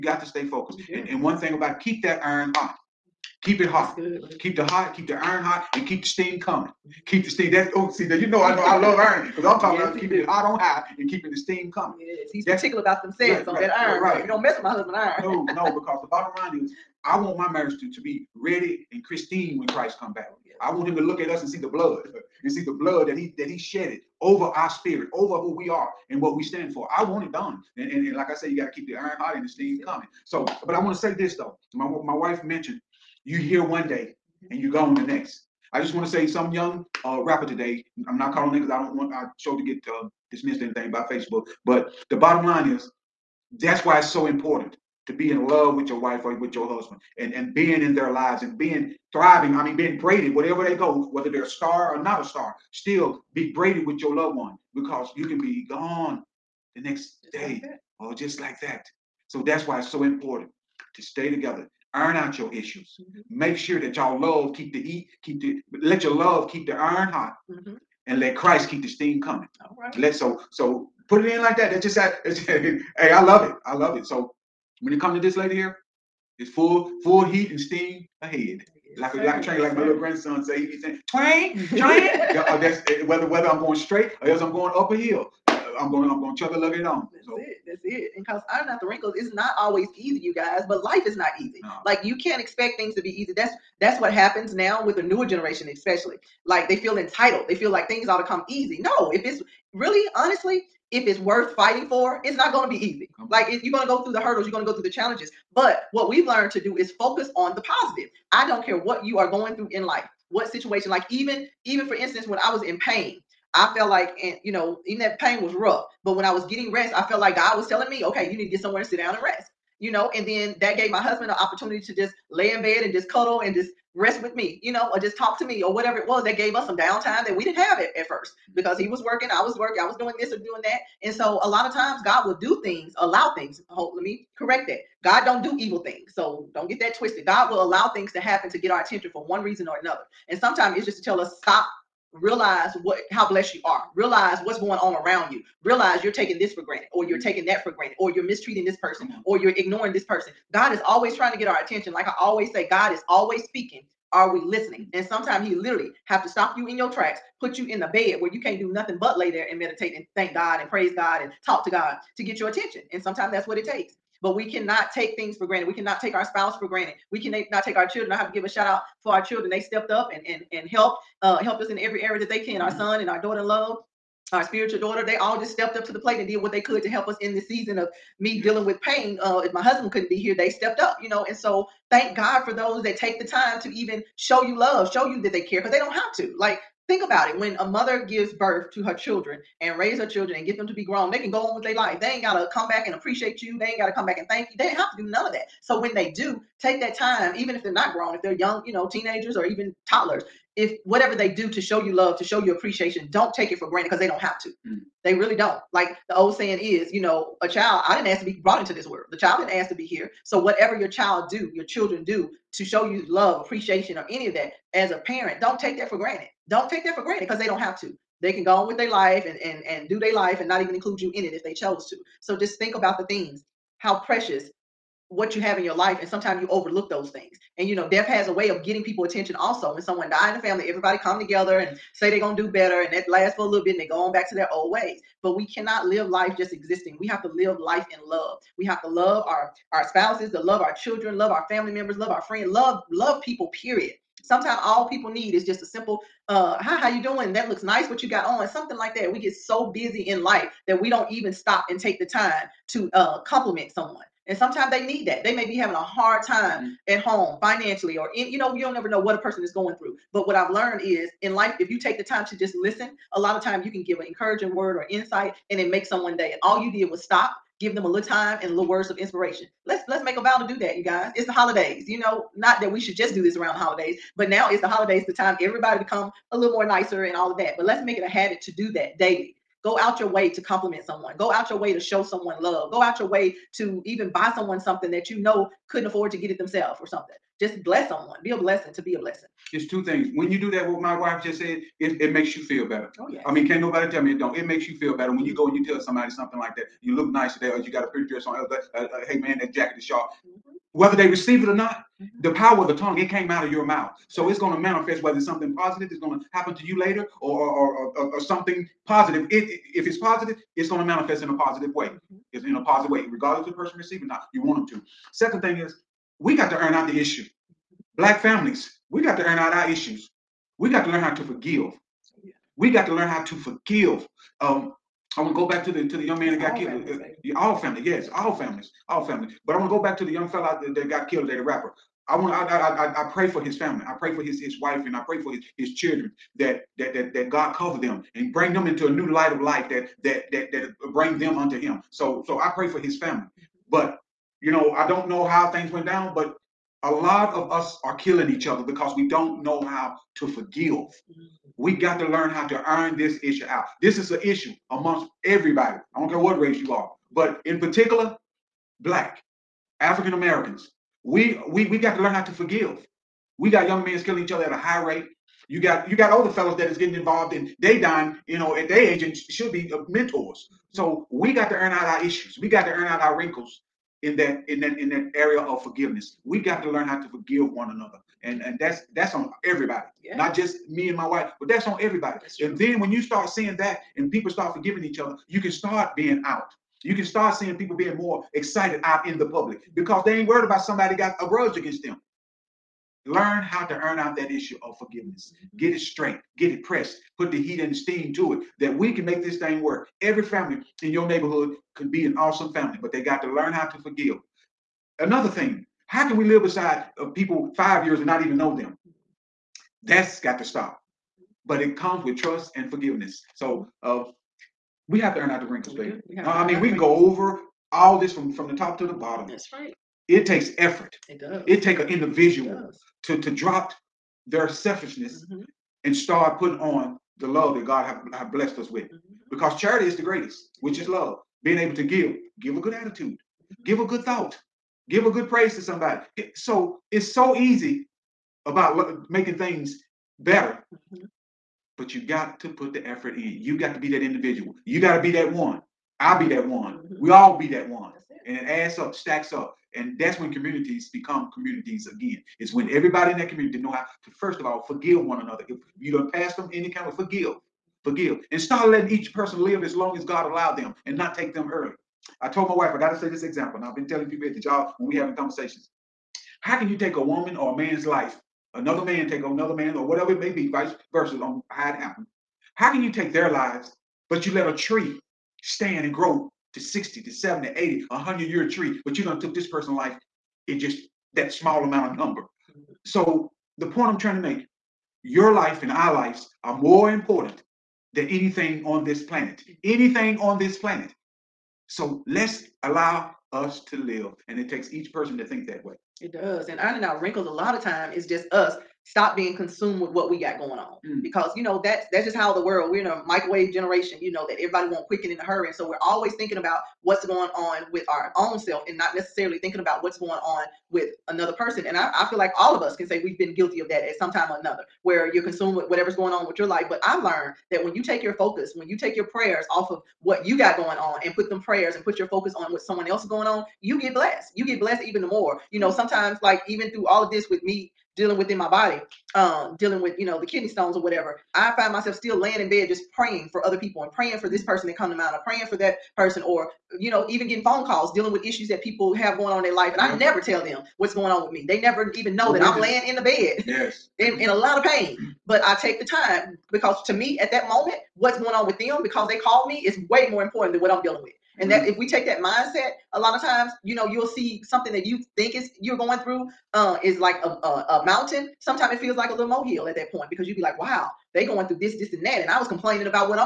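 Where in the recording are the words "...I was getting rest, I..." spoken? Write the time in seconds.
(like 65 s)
116 s.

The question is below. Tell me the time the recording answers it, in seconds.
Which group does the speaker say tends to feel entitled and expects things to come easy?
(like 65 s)
95 s.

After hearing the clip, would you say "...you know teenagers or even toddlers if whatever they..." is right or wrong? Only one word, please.
right.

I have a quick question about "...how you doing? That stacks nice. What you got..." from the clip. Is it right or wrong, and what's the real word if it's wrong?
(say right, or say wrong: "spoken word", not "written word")
wrong: "looks", not "stacks".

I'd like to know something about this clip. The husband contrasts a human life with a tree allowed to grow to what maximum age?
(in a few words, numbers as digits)
100.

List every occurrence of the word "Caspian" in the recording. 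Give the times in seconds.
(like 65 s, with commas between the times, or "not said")
not said.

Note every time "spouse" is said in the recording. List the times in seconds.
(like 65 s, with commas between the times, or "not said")
166 s, 239 s.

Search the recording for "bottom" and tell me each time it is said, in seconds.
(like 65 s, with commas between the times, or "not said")
16 s, 42 s, 418 s.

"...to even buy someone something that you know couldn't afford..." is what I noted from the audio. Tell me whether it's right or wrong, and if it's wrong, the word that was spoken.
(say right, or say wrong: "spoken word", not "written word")
right.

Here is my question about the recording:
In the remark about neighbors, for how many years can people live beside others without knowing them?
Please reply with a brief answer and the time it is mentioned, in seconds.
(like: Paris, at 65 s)
5, at 407 s.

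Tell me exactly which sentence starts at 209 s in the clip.
The child didn't ask to be here.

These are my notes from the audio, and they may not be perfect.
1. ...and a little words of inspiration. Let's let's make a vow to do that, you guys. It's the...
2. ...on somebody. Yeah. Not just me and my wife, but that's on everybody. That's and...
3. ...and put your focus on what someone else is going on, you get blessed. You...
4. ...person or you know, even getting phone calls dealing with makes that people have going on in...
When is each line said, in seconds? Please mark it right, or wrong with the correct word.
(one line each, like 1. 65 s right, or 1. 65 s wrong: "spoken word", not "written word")
1. 268 s right
2. 379 s wrong: "everybody", not "somebody"
3. 521 s right
4. 535 s wrong: "issues", not "makes".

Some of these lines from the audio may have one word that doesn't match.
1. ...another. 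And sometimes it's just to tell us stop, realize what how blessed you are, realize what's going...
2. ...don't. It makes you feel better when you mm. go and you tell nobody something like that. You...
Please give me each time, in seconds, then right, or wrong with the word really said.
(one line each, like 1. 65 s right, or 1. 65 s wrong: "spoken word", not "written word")
1. 139 s right
2. 294 s wrong: "somebody", not "nobody".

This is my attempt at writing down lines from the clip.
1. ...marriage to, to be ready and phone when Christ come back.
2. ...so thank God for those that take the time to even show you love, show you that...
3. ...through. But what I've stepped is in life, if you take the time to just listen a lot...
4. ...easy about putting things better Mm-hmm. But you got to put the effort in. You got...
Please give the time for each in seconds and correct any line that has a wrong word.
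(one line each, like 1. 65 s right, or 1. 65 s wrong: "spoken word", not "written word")
1. 17 s wrong: "pristine", not "phone"
2. 181 s right
3. 259 s wrong: "learned", not "stepped"
4. 437 s wrong: "making", not "putting".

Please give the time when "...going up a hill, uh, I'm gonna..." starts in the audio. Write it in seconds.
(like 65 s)
84 s.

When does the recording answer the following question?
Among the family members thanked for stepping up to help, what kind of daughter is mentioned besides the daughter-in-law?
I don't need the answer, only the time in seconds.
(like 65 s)
174 s.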